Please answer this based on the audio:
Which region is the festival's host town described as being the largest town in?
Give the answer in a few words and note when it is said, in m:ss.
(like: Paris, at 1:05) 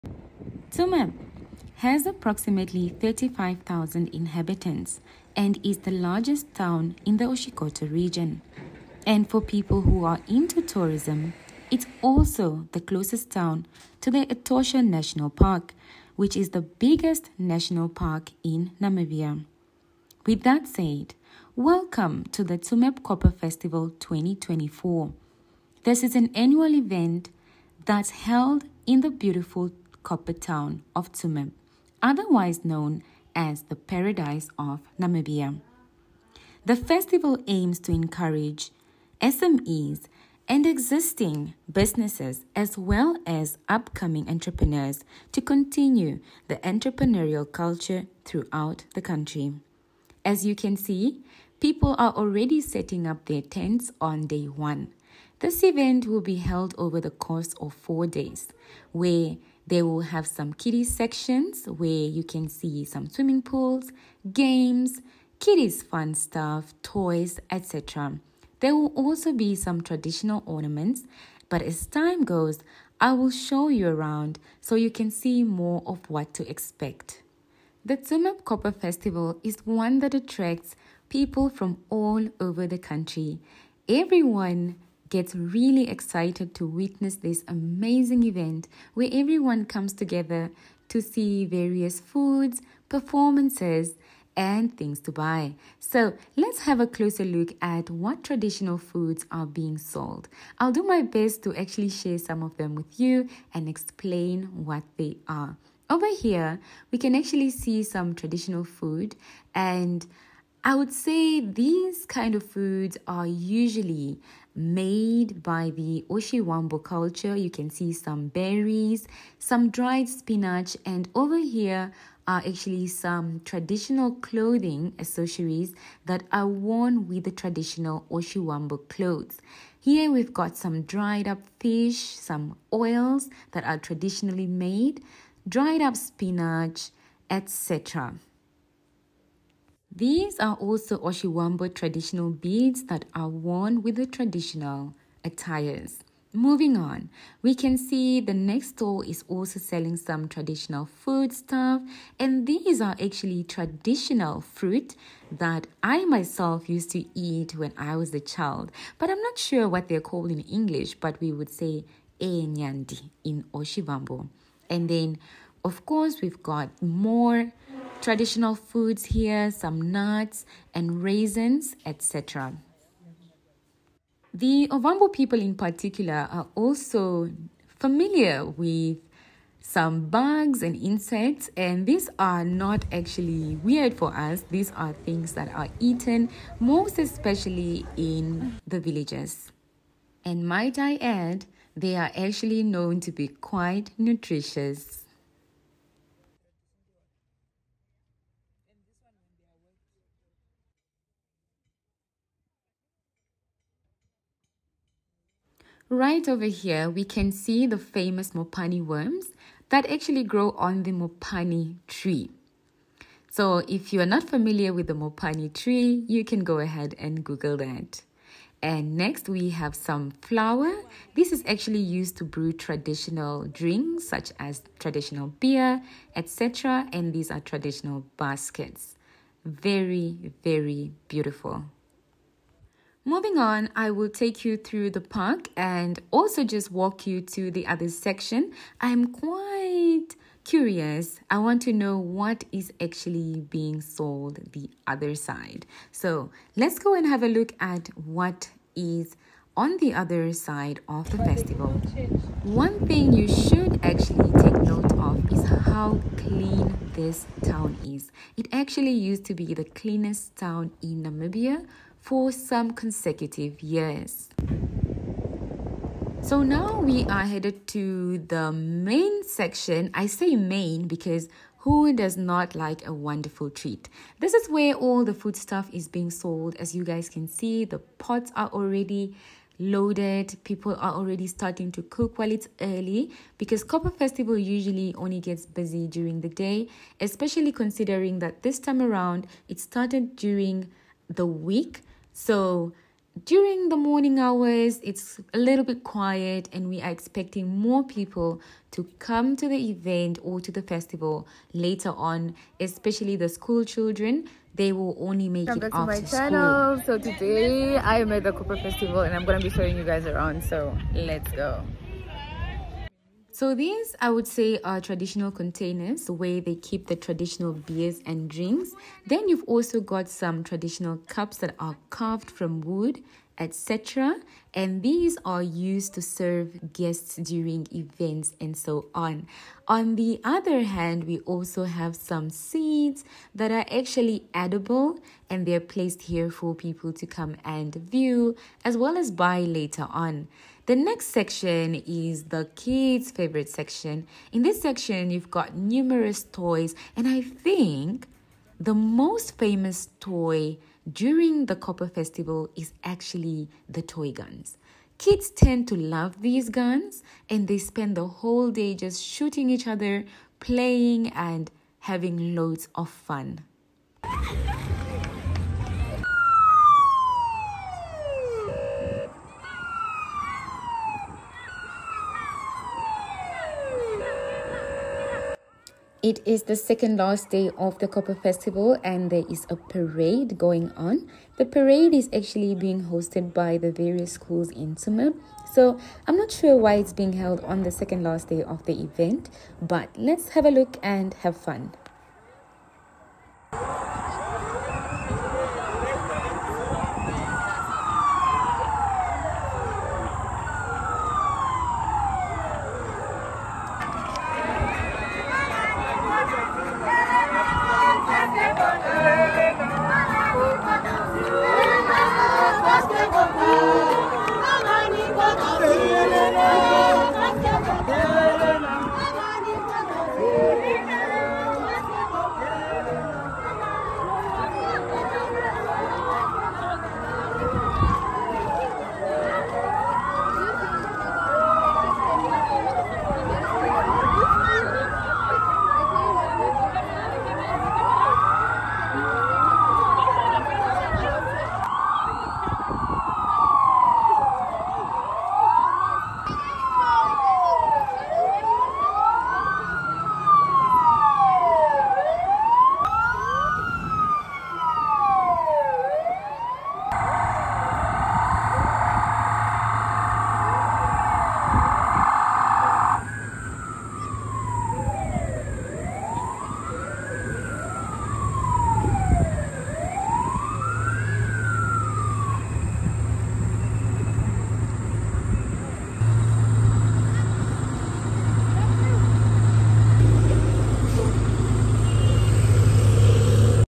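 Oshikoto, at 0:07.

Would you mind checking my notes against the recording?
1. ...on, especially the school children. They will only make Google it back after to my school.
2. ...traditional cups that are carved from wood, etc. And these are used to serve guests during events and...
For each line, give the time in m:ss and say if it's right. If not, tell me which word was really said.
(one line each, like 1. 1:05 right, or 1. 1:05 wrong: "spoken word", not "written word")
1. 5:01 wrong: "Welcome", not "Google"
2. 5:20 right.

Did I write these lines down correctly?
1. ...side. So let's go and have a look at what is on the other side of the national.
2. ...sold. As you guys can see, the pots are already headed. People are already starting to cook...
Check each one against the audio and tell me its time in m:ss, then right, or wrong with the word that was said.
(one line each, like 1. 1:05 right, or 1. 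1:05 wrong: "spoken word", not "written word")
1. 4:05 wrong: "festival", not "national"
2. 4:36 wrong: "loaded", not "headed".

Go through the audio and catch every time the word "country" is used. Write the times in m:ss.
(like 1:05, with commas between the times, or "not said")
0:49, 1:22.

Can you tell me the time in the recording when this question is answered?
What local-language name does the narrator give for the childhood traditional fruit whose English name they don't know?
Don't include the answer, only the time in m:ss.
2:42.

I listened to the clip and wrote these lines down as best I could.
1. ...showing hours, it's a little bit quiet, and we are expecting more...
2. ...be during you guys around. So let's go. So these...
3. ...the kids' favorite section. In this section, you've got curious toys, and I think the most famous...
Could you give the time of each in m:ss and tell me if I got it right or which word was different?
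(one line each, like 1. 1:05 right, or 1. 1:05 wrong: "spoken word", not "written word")
1. 4:53 wrong: "morning", not "showing"
2. 5:09 wrong: "showing", not "during"
3. 5:42 wrong: "numerous", not "curious".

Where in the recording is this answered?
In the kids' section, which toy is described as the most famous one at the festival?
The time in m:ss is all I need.
5:53.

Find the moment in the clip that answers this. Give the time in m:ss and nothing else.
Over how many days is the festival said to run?
0:57.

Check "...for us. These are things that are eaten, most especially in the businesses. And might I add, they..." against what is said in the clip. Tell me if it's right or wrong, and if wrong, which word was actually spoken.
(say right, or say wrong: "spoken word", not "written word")
wrong: "villages", not "businesses".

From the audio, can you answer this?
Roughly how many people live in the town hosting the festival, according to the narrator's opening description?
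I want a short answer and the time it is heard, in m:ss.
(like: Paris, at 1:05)
35,000, at 0:02.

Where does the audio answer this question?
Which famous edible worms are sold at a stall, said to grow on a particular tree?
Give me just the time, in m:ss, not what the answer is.
3:28.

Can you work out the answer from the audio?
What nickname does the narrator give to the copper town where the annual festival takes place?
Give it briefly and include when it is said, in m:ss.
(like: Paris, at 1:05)
Paradise of Namibia, at 0:33.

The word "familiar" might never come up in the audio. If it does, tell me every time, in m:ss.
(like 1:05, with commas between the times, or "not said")
2:57, 3:34.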